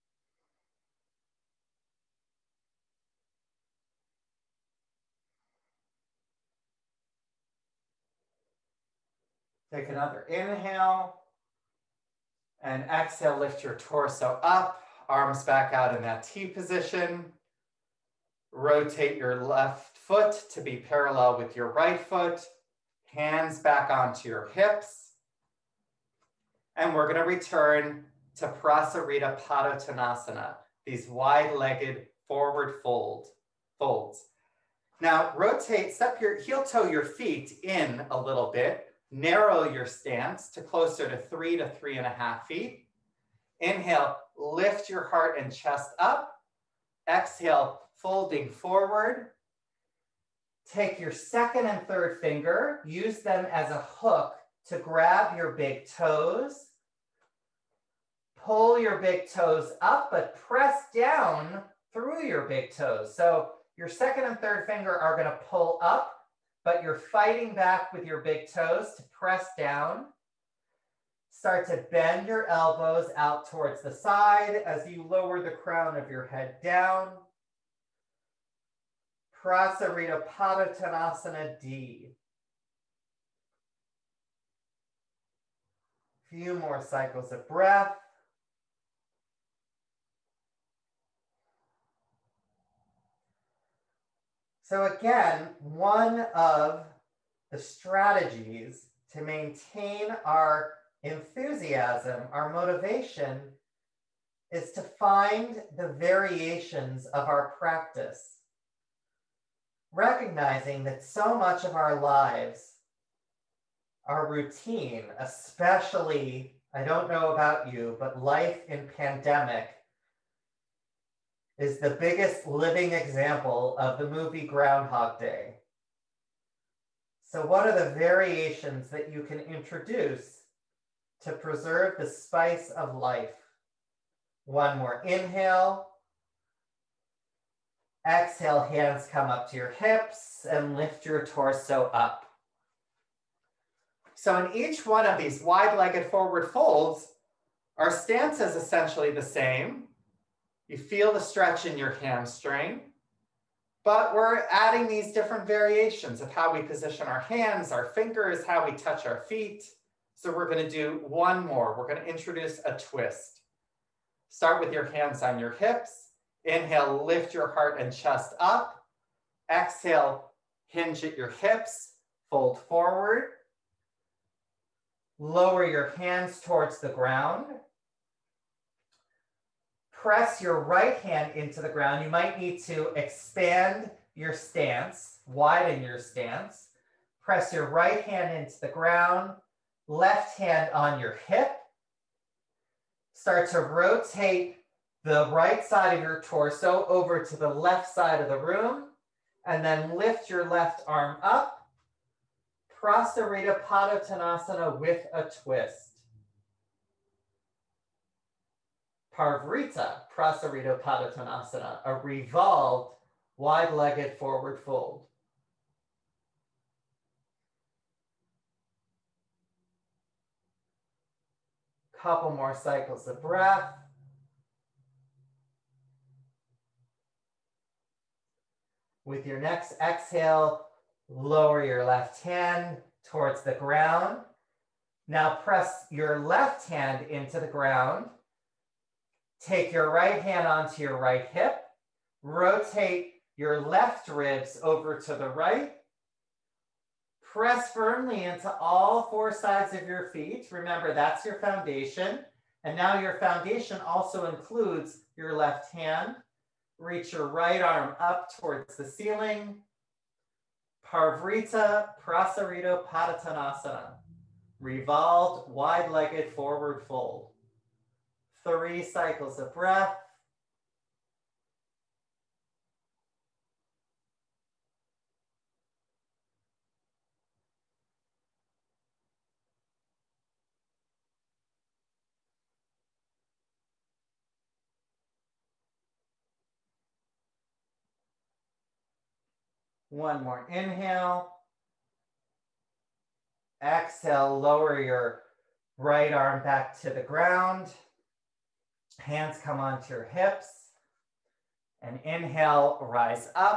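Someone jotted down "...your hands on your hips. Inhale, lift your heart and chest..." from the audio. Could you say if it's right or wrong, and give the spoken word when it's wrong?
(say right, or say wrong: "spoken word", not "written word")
right.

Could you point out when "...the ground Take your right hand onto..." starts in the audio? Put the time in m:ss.
3:57.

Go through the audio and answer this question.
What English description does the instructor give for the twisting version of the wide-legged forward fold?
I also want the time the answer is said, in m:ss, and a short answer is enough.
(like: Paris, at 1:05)
revolved wide legged forward fold, at 3:31.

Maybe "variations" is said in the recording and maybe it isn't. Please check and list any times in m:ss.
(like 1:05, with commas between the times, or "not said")
1:45, 2:07, 2:35.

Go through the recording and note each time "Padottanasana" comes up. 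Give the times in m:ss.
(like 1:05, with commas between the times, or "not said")
0:29, 1:20, 3:23, 3:30, 4:22.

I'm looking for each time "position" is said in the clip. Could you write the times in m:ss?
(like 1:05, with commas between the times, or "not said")
0:16, 2:36.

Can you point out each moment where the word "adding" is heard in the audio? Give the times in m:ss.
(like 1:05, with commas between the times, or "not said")
2:34.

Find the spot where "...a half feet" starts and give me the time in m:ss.
0:42.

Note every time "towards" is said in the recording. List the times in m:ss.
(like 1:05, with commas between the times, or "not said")
1:13, 2:56, 3:53, 4:18.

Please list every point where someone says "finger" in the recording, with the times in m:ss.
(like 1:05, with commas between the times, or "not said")
0:52, 1:04, 2:37.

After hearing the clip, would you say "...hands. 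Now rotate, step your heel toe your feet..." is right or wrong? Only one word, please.
wrong.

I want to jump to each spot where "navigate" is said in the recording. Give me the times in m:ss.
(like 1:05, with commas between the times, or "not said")
not said.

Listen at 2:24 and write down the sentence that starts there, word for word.
So, in each one of these wide legged forward folds, our stance is essentially the same.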